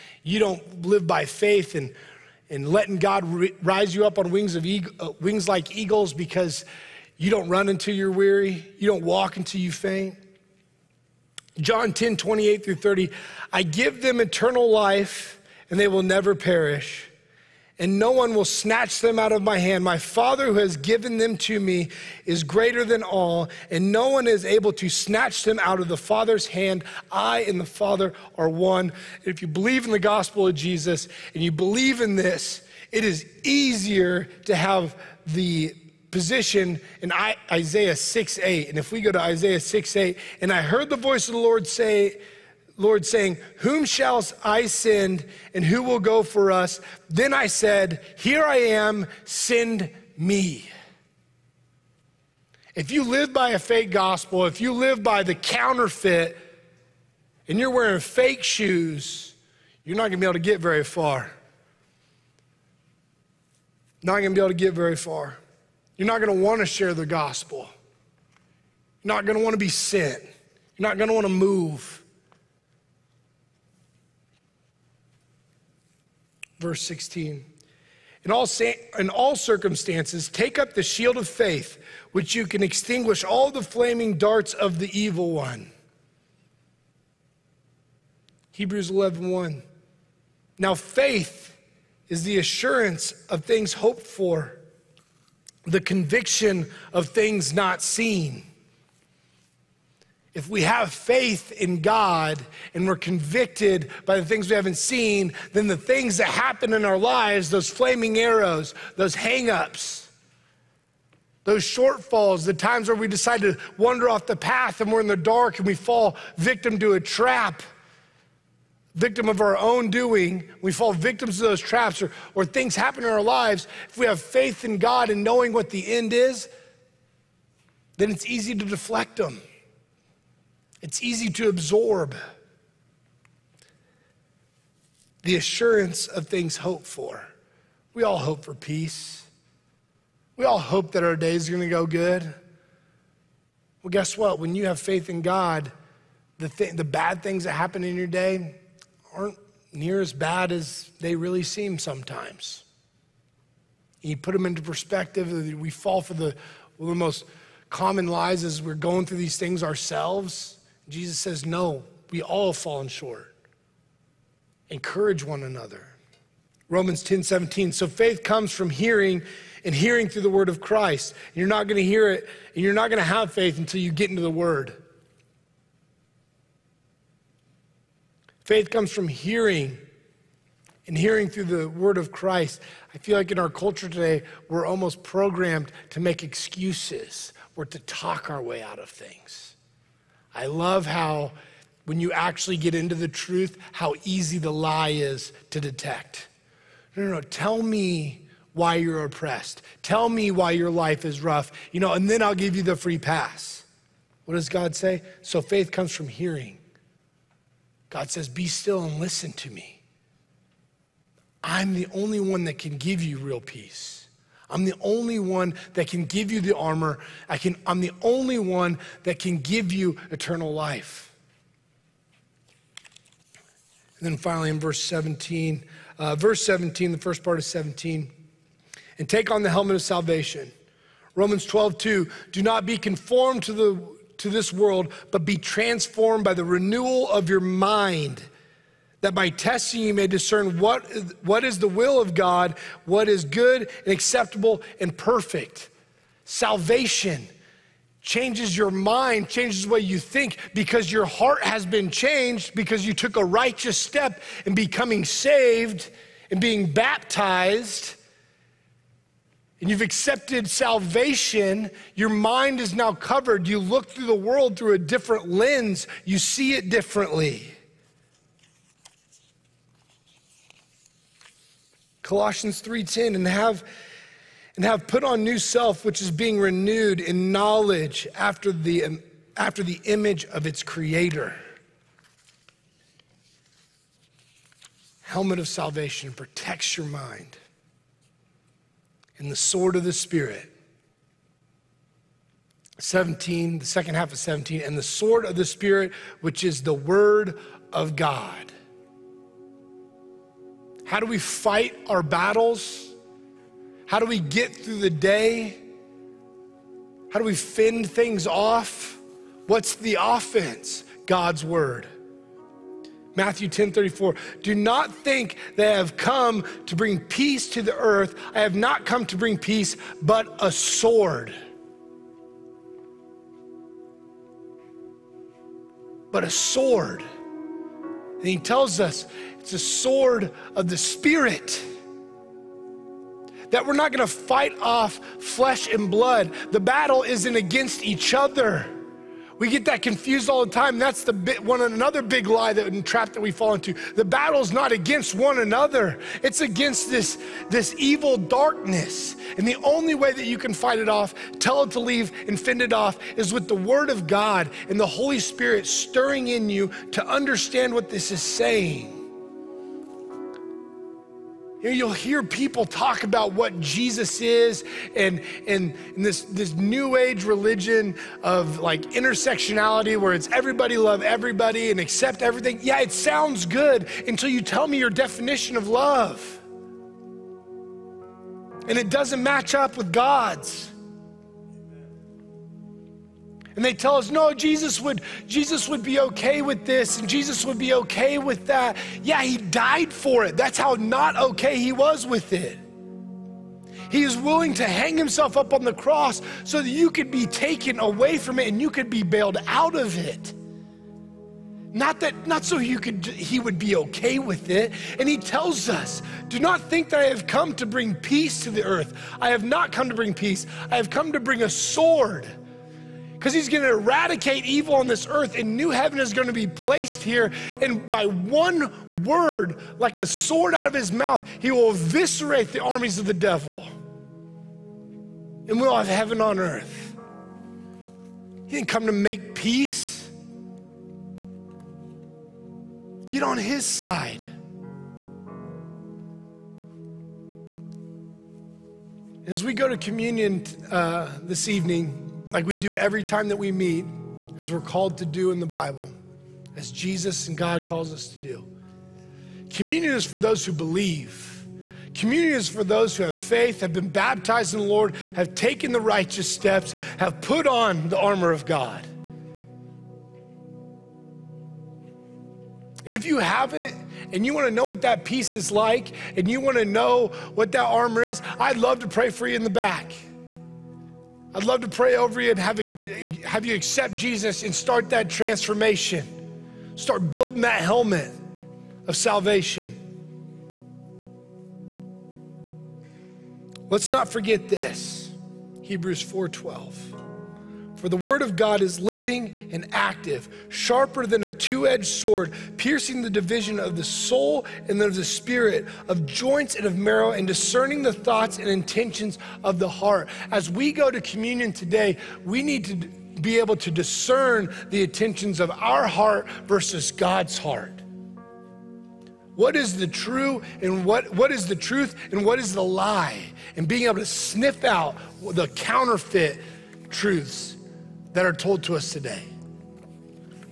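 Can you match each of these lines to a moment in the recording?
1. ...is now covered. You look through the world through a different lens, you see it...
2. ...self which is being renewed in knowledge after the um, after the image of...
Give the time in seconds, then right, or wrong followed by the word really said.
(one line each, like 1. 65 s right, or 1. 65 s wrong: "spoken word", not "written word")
1. 262 s right
2. 275 s right.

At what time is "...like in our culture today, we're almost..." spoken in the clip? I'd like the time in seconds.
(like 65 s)
183 s.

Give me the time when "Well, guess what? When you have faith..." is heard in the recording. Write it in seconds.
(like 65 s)
143 s.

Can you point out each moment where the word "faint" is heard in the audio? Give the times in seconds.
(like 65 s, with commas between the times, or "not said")
9 s.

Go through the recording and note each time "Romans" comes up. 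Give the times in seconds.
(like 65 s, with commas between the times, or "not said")
166 s, 231 s.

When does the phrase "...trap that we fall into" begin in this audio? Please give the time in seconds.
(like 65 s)
342 s.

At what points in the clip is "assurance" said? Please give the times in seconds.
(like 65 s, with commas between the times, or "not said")
92 s, 135 s.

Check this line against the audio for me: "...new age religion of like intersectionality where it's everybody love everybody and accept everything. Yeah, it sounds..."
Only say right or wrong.
right.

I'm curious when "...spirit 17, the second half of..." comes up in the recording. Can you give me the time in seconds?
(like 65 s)
289 s.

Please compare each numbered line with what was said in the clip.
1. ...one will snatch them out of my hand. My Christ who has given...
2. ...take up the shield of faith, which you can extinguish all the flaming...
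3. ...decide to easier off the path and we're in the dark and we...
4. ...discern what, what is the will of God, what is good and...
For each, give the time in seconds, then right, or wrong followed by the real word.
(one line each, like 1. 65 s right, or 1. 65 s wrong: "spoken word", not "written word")
1. 18 s wrong: "Father", not "Christ"
2. 80 s right
3. 113 s wrong: "wander", not "easier"
4. 240 s right.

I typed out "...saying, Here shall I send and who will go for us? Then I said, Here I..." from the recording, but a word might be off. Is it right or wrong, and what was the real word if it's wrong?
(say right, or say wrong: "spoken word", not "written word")
wrong: "Whom", not "Here".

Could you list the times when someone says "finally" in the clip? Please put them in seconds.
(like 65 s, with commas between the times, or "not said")
224 s.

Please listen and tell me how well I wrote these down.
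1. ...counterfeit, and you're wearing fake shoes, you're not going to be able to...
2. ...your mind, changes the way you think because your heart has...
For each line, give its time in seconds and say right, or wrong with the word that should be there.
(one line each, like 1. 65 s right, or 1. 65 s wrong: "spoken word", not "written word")
1. 55 s right
2. 248 s right.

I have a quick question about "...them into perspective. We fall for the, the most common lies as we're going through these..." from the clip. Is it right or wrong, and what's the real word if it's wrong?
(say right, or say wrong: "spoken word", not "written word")
right.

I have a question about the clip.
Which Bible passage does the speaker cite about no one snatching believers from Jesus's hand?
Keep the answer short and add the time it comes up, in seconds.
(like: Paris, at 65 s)
John 10:28-30, at 11 s.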